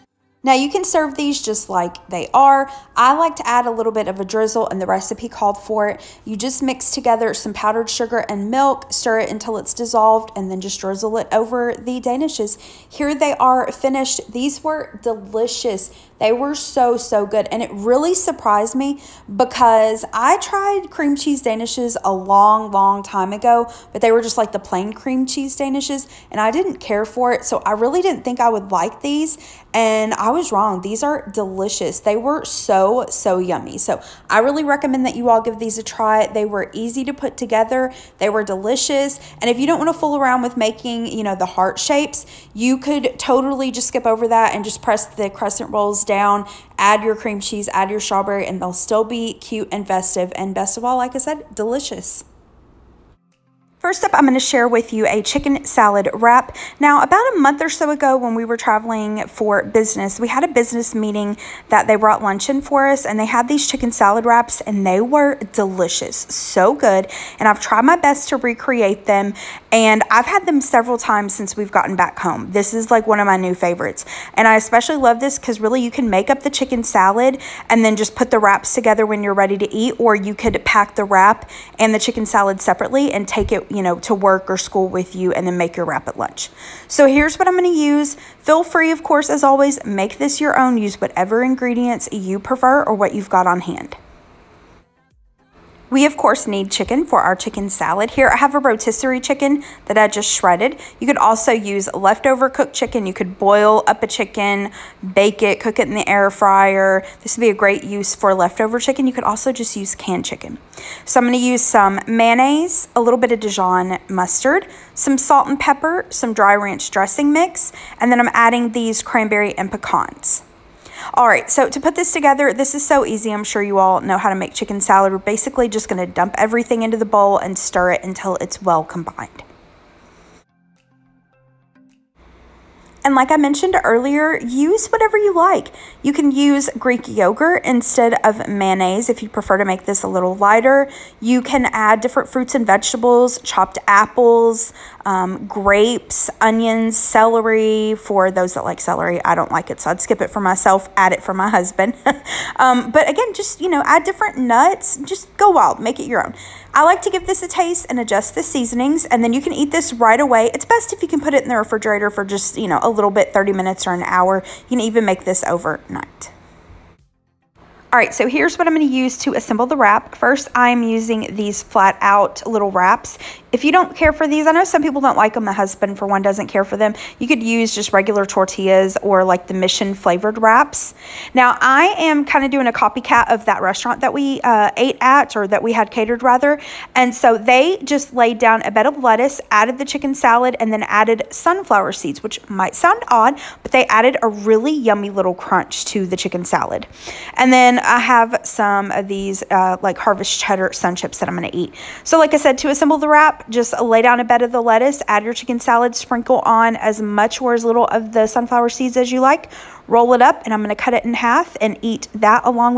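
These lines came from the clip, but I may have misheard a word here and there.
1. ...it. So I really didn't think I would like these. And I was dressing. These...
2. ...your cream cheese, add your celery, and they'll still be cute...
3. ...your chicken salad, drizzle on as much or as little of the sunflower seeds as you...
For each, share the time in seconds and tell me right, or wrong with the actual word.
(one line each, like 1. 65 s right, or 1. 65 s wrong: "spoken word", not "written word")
1. 27 s wrong: "wrong", not "dressing"
2. 47 s wrong: "strawberry", not "celery"
3. 205 s wrong: "sprinkle", not "drizzle".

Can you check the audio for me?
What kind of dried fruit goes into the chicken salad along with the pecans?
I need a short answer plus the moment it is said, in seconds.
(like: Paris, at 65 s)
cranberry, at 119 s.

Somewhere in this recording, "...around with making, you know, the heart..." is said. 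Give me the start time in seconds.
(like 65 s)
40 s.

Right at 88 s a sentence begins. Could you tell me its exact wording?
Feel free, of course, as always, make this your own.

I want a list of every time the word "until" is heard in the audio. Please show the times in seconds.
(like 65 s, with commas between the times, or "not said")
9 s, 128 s.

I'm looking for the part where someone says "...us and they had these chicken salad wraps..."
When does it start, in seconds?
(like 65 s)
62 s.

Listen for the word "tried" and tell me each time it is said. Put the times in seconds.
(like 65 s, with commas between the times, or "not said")
20 s, 67 s.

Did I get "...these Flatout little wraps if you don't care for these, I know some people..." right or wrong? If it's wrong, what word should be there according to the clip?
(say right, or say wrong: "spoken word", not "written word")
right.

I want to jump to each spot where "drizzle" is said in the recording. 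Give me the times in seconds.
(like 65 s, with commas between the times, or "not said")
4 s, 10 s.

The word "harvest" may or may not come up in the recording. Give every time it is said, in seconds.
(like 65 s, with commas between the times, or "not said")
199 s.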